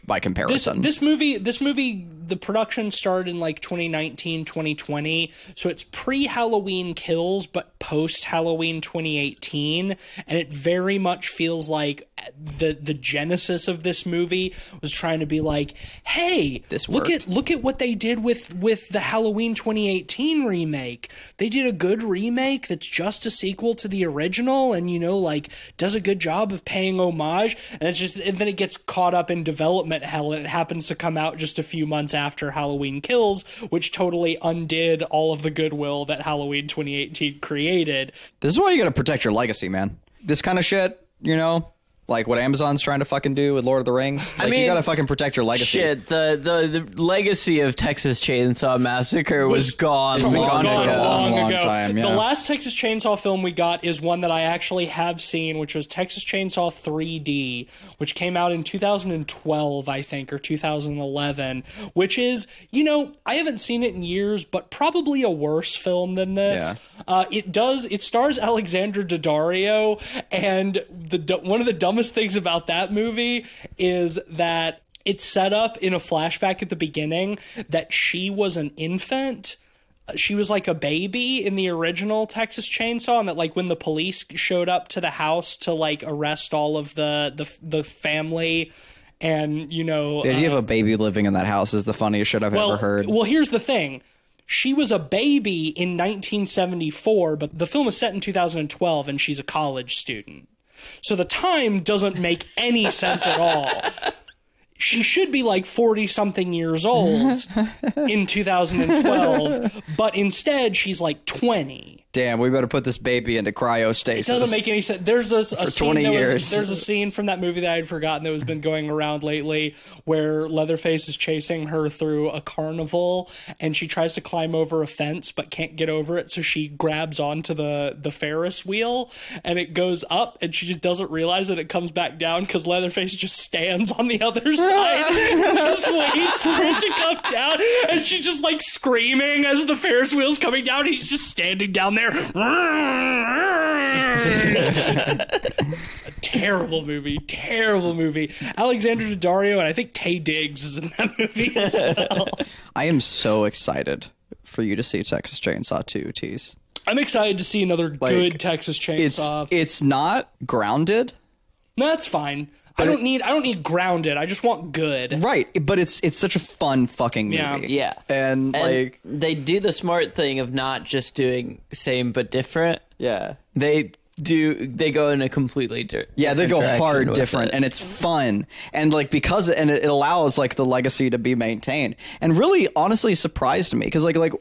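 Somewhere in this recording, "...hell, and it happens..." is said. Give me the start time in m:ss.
0:30.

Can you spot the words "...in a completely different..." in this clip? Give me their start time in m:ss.
2:55.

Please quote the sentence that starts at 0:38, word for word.
This is why you got to protect your legacy, man.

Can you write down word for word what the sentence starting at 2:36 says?
I'm excited to see another like, good Texas Chainsaw.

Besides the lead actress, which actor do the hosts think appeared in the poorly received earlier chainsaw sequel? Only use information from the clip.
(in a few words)
Taye Diggs.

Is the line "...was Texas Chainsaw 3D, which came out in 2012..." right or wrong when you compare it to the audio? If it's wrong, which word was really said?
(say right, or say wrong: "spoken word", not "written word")
right.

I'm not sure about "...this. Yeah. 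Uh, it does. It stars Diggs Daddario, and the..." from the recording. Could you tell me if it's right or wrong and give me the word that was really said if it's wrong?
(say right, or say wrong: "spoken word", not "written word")
wrong: "Alexandra", not "Diggs".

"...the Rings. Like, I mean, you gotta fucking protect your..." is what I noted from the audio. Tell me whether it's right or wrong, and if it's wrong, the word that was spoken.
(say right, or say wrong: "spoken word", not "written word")
right.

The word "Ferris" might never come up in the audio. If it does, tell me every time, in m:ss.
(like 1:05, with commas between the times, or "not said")
2:08, 2:19.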